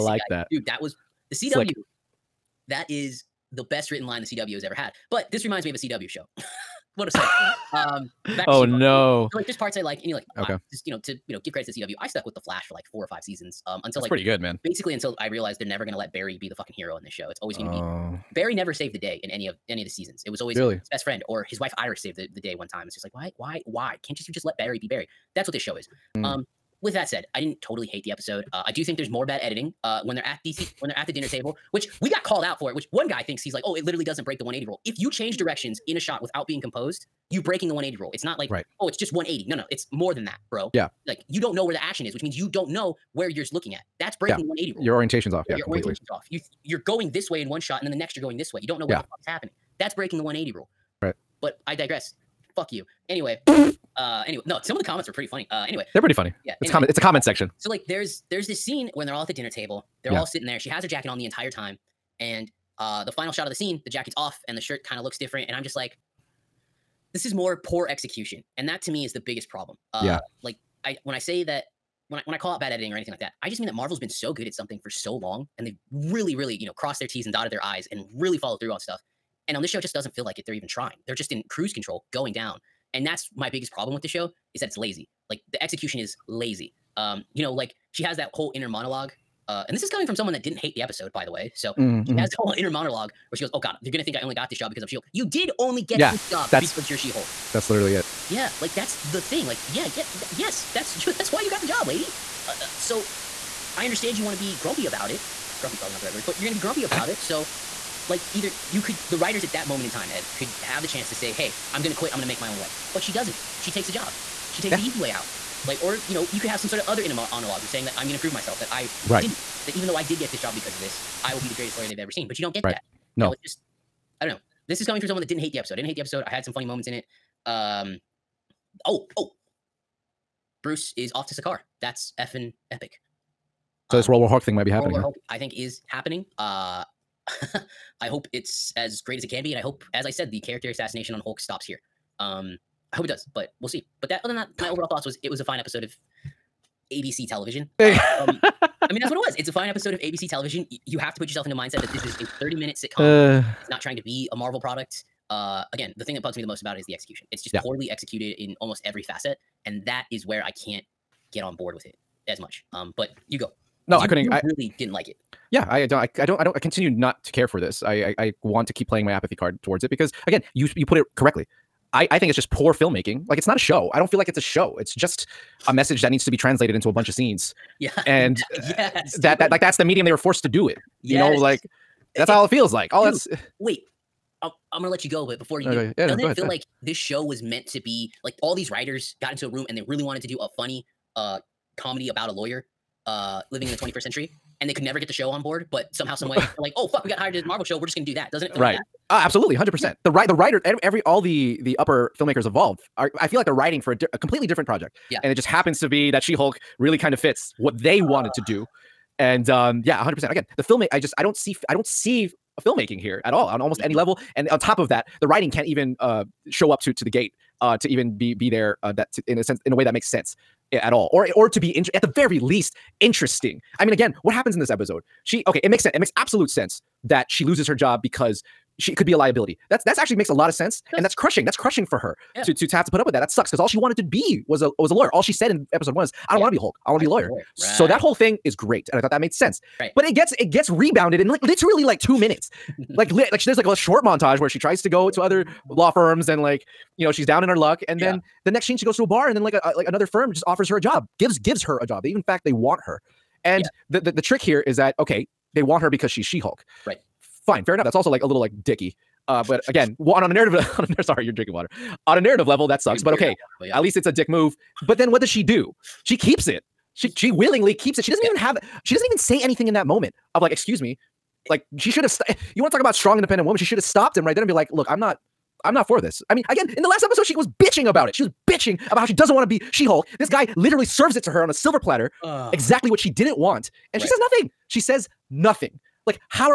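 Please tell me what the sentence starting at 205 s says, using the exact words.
Yeah, and it just happens to be that She Hulk really kind of fits what they wanted to do.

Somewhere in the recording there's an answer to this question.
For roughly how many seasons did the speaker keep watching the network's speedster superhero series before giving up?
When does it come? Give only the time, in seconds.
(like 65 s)
12 s.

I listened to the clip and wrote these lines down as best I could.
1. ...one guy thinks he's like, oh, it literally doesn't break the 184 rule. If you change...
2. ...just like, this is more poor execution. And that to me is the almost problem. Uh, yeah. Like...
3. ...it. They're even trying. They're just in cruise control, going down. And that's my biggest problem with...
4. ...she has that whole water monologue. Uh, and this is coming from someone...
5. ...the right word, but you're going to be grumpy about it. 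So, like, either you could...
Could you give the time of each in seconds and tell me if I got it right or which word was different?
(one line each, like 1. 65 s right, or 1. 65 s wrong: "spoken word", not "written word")
1. 32 s wrong: "180", not "184"
2. 65 s wrong: "biggest", not "almost"
3. 80 s right
4. 87 s wrong: "inner", not "water"
5. 105 s right.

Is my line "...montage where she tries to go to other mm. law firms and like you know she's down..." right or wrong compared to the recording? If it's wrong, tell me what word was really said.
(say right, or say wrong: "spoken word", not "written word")
right.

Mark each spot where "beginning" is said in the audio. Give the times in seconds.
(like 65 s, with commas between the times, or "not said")
not said.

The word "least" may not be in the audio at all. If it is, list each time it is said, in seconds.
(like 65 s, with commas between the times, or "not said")
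222 s, 263 s.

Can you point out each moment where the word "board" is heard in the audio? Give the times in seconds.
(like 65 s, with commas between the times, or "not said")
161 s, 195 s.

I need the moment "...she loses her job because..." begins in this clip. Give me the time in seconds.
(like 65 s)
227 s.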